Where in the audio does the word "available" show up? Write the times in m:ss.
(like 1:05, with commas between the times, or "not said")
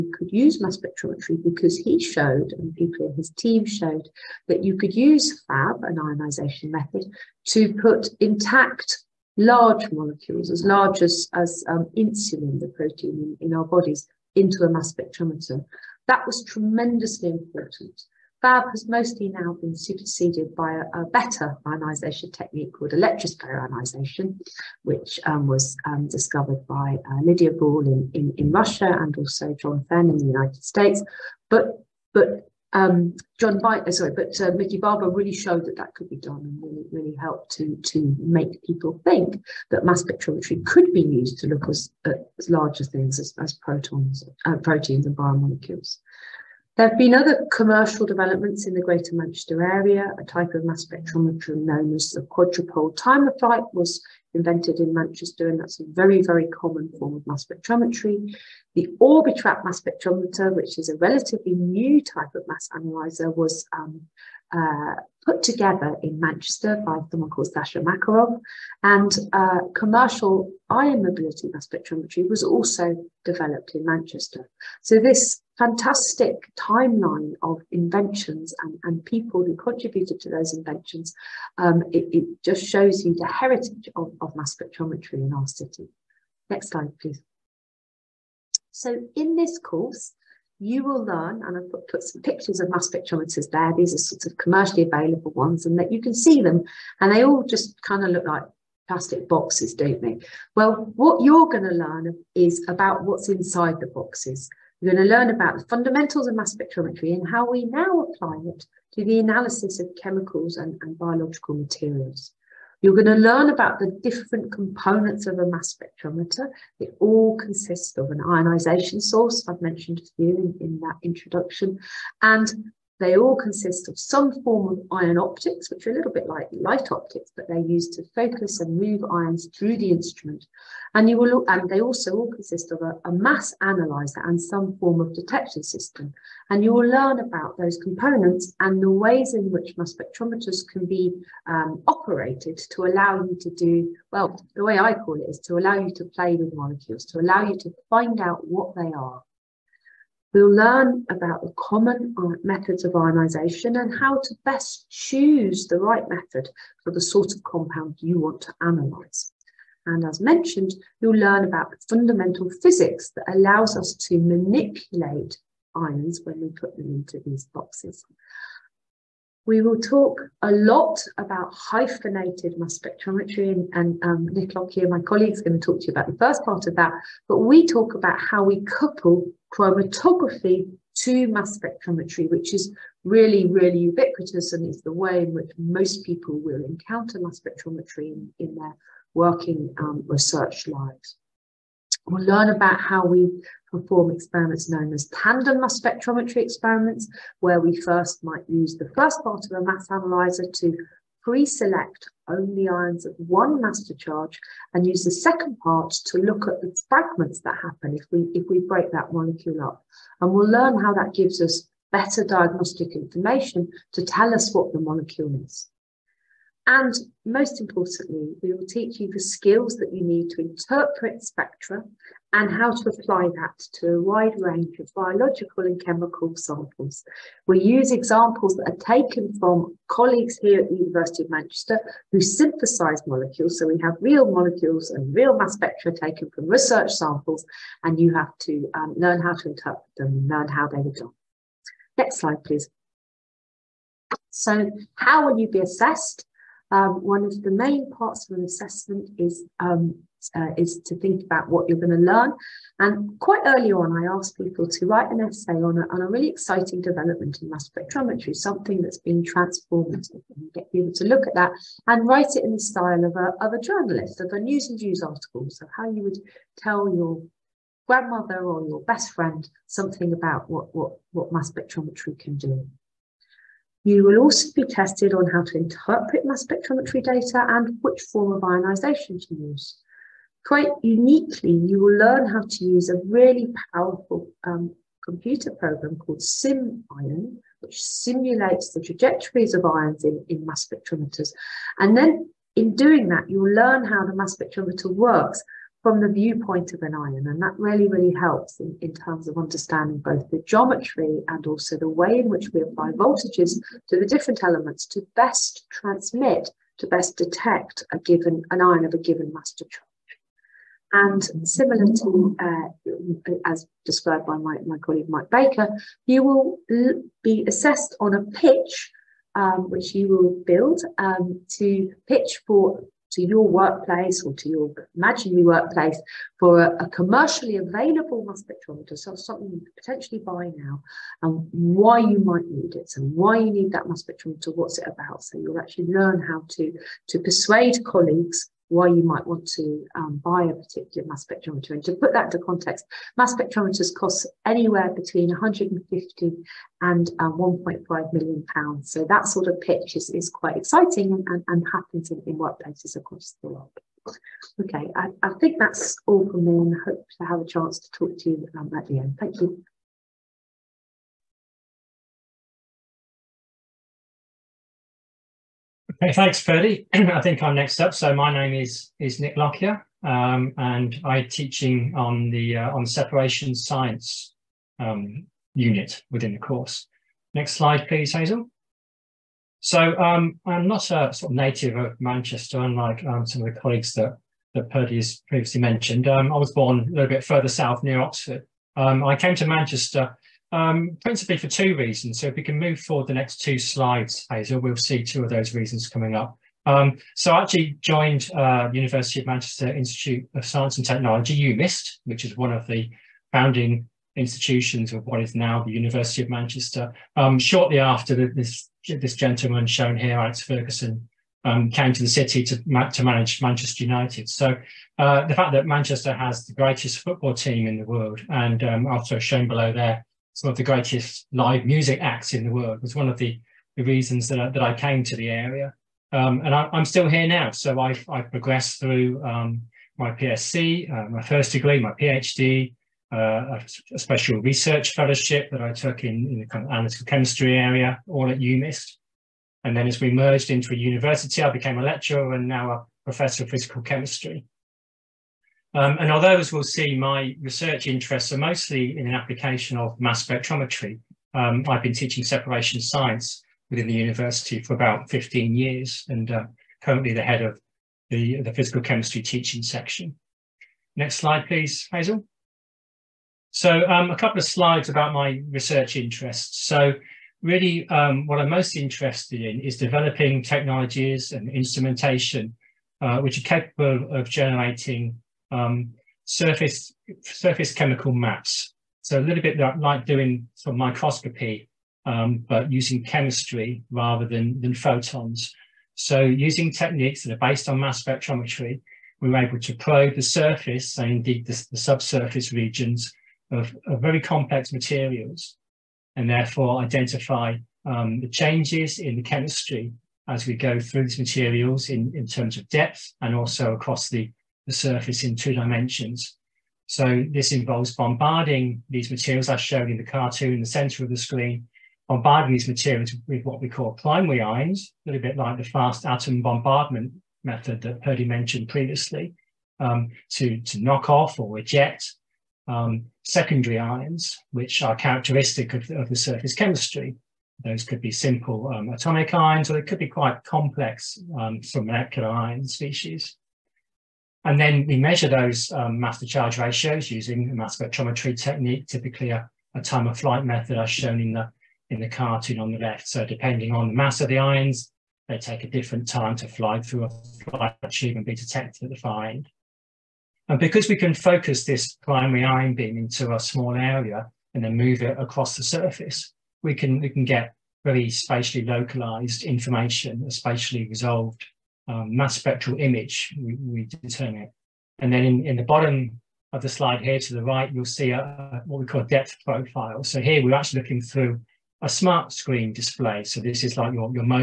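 1:34, 5:27.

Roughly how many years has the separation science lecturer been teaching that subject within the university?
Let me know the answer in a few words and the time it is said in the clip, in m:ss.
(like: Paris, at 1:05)
15 years, at 7:35.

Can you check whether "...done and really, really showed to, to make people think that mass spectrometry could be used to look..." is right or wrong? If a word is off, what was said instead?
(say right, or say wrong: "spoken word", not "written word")
wrong: "helped", not "showed".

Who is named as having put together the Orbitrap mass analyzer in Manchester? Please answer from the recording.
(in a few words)
Sasha Makarov.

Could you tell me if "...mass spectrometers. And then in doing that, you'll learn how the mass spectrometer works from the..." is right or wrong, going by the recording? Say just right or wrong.
right.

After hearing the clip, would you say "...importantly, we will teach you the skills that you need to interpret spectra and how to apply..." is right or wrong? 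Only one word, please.
right.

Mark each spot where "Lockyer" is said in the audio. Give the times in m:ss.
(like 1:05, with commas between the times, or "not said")
2:54, 6:09.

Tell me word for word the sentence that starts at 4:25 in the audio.
So, how you would tell your grandmother or your best friend something about what, what, what mass spectrometry can do.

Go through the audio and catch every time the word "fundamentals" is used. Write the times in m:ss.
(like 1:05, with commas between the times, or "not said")
1:45, 2:41.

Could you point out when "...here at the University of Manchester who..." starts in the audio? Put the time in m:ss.
3:50.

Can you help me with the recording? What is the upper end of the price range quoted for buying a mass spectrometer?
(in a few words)
1.5 million pounds.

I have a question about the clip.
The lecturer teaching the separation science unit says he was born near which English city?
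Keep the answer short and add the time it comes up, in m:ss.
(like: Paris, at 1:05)
Oxford, at 6:27.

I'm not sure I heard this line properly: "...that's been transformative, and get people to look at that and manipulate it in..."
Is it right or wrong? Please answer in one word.
wrong.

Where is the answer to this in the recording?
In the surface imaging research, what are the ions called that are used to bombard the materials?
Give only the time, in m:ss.
8:33.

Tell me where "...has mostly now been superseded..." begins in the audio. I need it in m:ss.
0:18.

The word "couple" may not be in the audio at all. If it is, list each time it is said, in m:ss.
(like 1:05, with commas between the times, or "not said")
2:58, 7:44.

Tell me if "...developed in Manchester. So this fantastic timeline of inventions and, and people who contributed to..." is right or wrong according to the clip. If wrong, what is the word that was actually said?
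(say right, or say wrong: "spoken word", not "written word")
right.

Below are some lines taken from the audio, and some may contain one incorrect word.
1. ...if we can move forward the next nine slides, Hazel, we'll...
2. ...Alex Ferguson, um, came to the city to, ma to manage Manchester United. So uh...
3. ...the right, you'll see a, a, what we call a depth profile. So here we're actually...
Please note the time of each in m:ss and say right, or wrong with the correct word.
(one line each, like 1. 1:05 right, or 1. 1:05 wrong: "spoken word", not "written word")
1. 6:32 wrong: "two", not "nine"
2. 6:50 right
3. 9:27 right.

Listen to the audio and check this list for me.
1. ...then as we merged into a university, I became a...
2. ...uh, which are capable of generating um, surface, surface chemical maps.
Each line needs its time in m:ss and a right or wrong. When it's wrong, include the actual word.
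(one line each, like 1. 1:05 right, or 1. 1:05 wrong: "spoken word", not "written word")
1. 7:19 right
2. 7:52 right.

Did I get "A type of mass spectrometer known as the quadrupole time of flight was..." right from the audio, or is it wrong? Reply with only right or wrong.
right.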